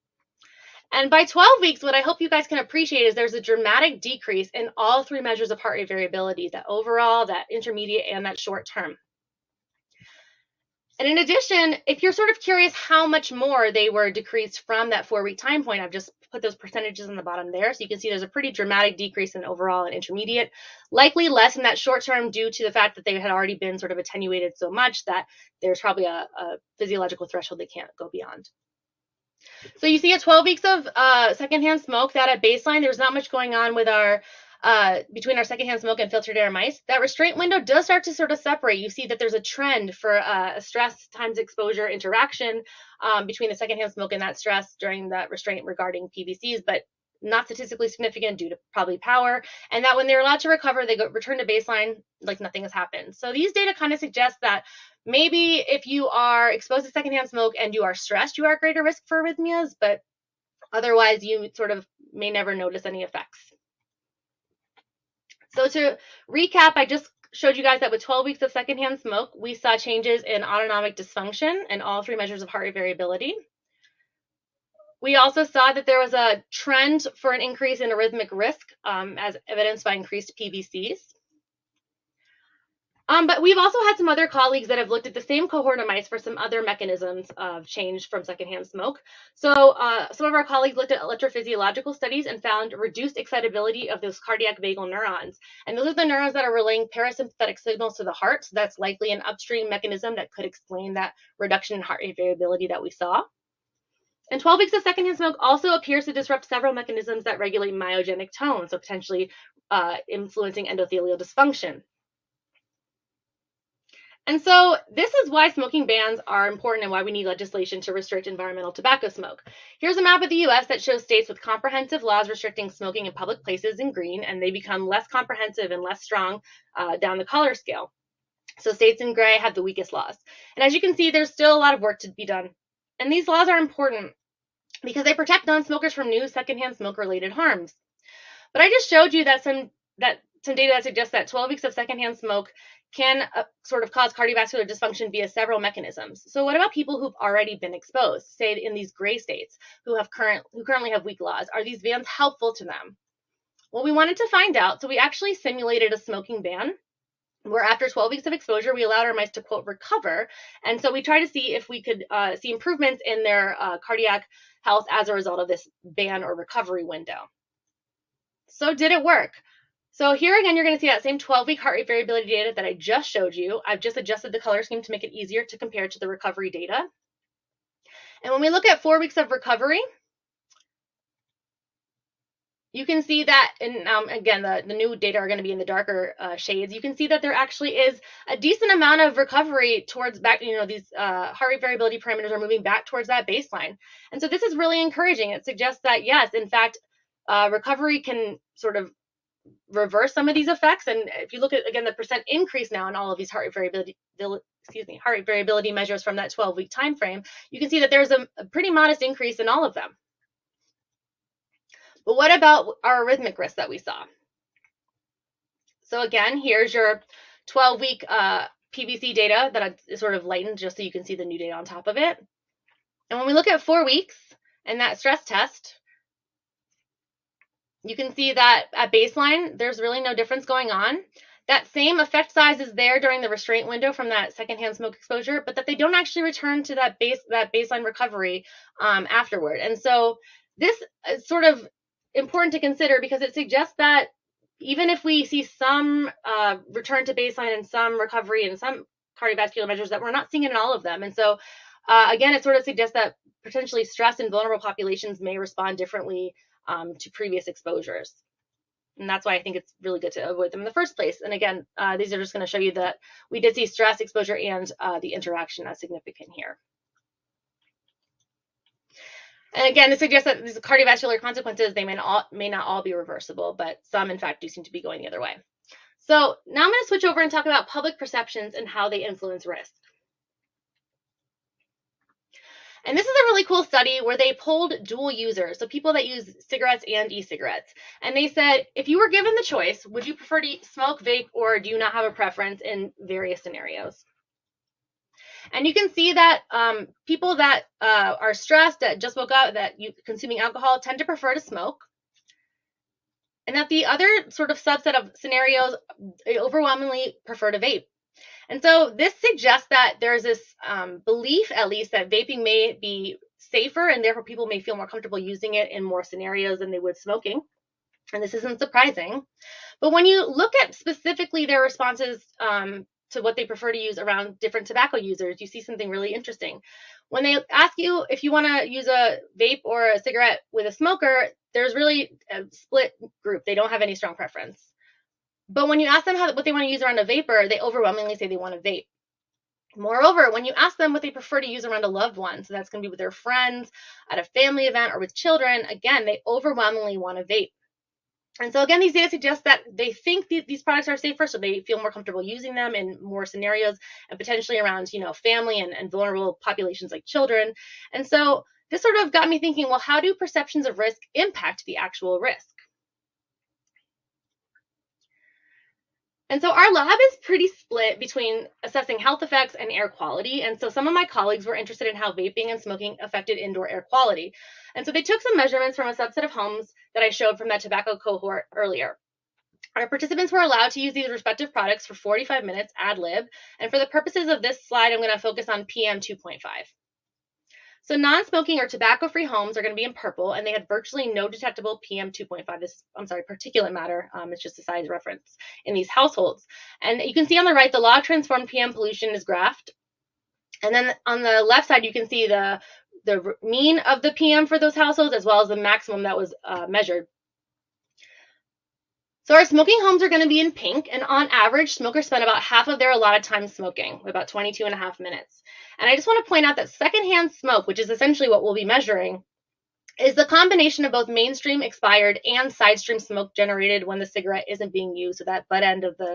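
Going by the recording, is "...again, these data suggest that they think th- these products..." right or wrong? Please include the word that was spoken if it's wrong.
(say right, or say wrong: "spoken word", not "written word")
right.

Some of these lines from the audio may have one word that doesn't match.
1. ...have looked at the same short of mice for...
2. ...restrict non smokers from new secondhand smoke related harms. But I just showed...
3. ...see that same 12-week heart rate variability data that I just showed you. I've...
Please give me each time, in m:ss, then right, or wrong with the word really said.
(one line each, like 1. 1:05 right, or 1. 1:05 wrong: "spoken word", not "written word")
1. 1:24 wrong: "cohort", not "short"
2. 2:15 wrong: "protect", not "restrict"
3. 2:50 right.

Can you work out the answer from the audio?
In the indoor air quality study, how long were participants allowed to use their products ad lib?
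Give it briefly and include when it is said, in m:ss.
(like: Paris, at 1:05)
45 minutes, at 6:21.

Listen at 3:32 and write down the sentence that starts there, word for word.
But what about our arrhythmic risk that we saw?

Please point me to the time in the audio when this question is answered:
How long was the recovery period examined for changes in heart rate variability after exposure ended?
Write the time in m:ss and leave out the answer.
2:58.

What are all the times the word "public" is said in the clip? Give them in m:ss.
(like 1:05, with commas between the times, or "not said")
2:03, 4:37.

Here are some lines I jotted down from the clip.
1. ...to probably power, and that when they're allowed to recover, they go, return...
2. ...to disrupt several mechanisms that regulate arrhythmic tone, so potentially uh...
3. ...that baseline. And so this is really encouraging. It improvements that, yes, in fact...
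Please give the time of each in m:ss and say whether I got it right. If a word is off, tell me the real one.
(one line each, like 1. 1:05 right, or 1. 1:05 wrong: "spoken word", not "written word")
1. 0:48 right
2. 1:46 wrong: "myogenic", not "arrhythmic"
3. 3:13 wrong: "suggests", not "improvements".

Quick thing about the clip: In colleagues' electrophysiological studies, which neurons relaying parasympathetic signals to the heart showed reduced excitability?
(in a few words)
Cardiac vagal neurons.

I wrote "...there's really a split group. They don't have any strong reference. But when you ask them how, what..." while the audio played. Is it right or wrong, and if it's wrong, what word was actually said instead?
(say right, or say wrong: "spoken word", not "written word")
wrong: "preference", not "reference".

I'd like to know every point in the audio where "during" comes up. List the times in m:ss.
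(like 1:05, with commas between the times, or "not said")
0:44, 3:52.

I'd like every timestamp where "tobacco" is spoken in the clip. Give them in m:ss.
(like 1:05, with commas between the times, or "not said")
1:58, 5:24, 6:17, 6:28.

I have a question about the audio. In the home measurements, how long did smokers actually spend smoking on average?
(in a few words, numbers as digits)
22.5 minutes.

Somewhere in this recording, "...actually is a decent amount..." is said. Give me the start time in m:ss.
3:07.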